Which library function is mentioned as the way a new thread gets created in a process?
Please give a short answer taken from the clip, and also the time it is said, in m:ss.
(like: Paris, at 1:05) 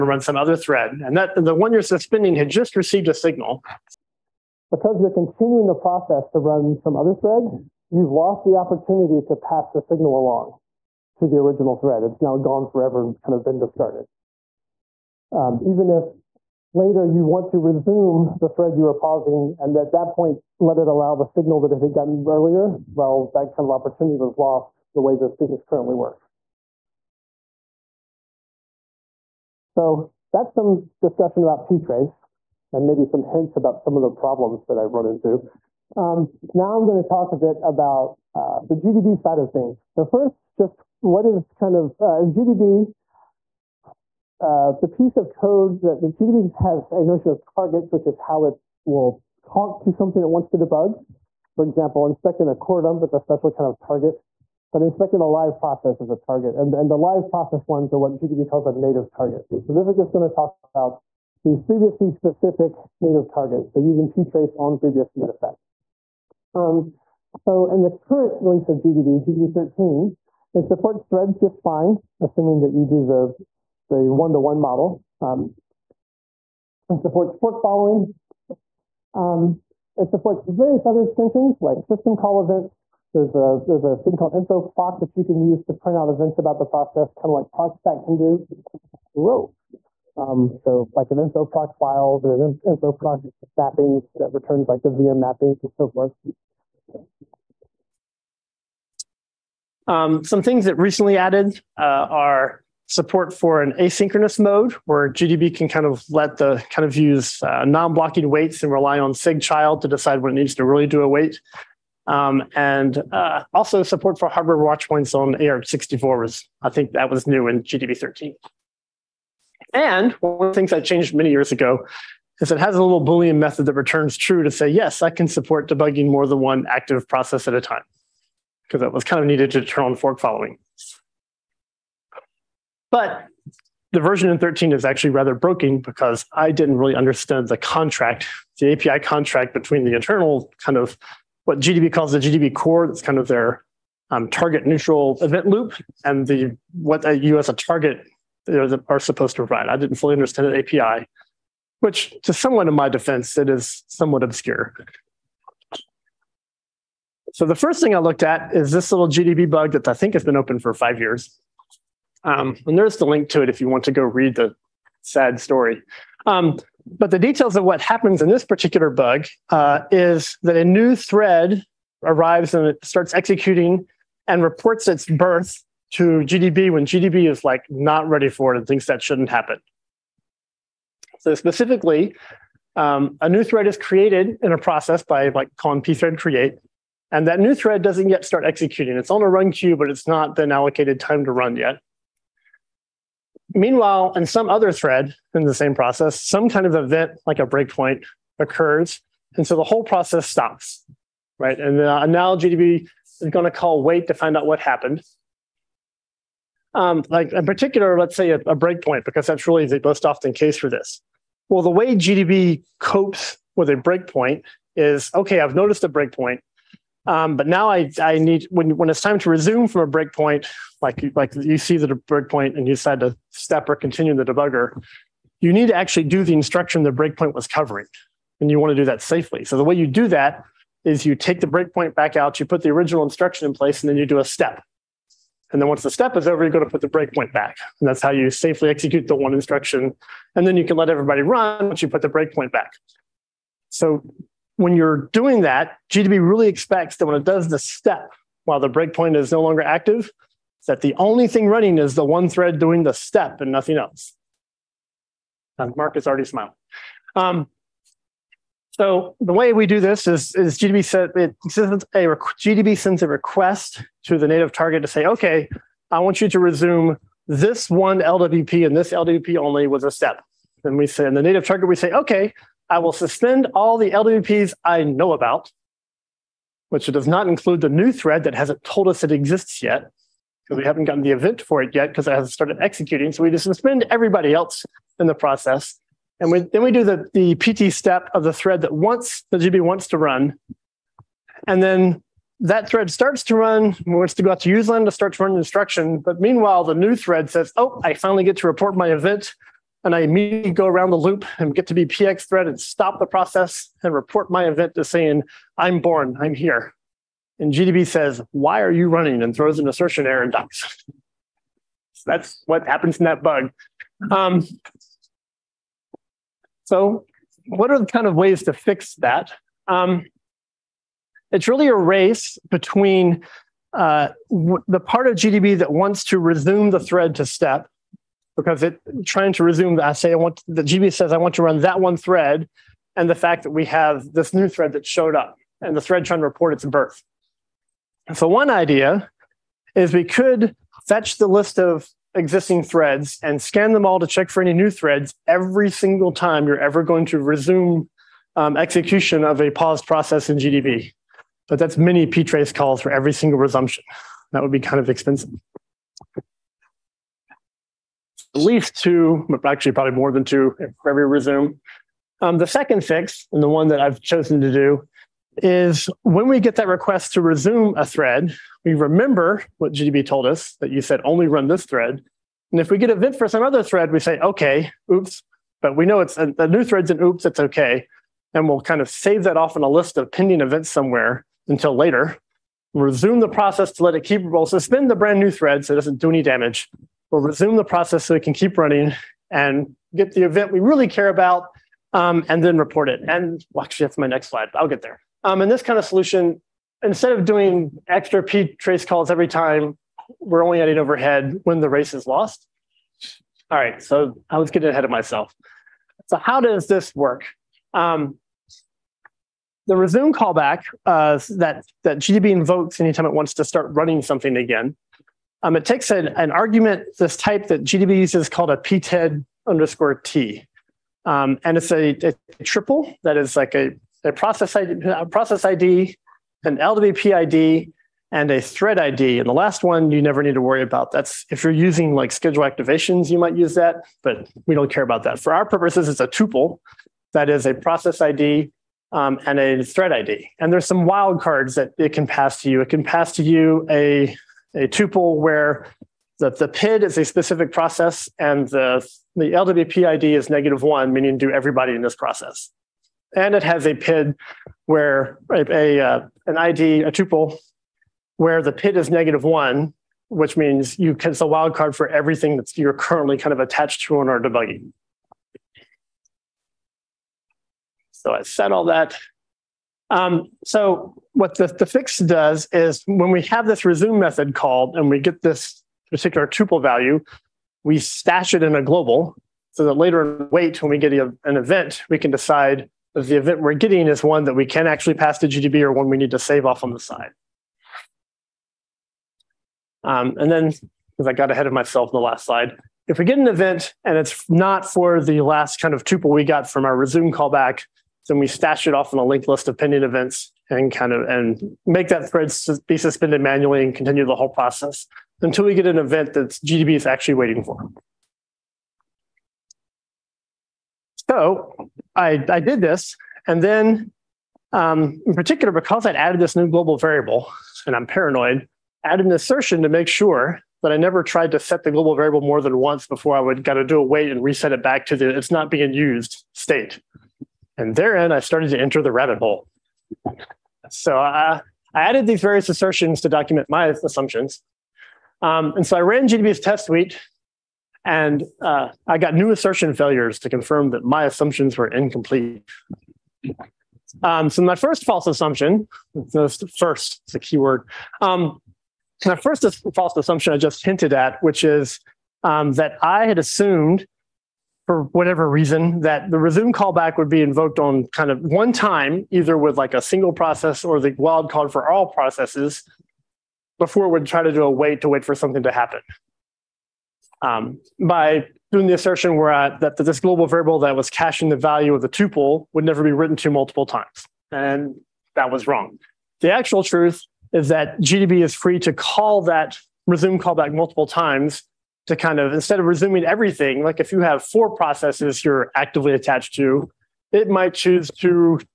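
pthread create, at 3:05.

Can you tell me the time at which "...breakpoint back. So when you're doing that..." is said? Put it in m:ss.
4:02.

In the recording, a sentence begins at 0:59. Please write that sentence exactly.
So this is just going to talk about the FreeBSD specific native target.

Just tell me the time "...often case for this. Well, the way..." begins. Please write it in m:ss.
3:30.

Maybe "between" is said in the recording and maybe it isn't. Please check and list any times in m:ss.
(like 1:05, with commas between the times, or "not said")
2:19, 5:22.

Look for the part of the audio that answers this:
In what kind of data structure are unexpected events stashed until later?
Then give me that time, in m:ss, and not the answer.
8:19.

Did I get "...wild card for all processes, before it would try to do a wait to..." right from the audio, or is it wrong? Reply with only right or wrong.
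right.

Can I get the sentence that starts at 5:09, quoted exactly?
And throws an assertion error and dies.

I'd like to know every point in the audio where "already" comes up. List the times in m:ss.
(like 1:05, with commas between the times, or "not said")
4:16.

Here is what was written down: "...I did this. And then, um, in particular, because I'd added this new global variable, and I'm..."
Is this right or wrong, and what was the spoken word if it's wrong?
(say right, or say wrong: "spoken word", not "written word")
right.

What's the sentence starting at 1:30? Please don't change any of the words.
Um, so like an info proc files and an info proc mappings that returns like the VM mappings and so forth.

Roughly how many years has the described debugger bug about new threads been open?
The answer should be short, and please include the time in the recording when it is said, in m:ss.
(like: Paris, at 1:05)
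5, at 2:40.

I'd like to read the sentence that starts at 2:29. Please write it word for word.
I didn't fully understand the API, which, to someone in my defense, it is somewhat obscure.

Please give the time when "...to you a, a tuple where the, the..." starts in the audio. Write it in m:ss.
7:23.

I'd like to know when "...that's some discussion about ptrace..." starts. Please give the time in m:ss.
0:30.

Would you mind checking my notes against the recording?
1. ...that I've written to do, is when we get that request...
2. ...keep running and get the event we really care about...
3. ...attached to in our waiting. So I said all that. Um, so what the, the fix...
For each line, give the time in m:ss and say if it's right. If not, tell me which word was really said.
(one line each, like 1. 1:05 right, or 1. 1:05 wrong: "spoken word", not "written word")
1. 6:03 wrong: "chosen", not "written"
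2. 6:28 right
3. 7:43 wrong: "debugging", not "waiting".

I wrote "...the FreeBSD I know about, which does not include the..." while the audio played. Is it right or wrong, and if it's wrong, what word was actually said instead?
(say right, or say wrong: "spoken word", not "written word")
wrong: "LWPs", not "FreeBSD".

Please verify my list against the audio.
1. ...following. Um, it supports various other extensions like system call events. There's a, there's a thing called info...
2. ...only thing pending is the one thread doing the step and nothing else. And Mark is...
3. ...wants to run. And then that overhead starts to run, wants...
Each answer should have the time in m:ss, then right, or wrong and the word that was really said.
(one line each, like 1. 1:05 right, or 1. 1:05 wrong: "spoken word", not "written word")
1. 1:17 right
2. 4:10 wrong: "running", not "pending"
3. 4:49 wrong: "thread", not "overhead".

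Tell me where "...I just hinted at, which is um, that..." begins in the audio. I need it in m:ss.
9:10.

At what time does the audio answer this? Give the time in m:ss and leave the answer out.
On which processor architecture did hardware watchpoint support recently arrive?
1:55.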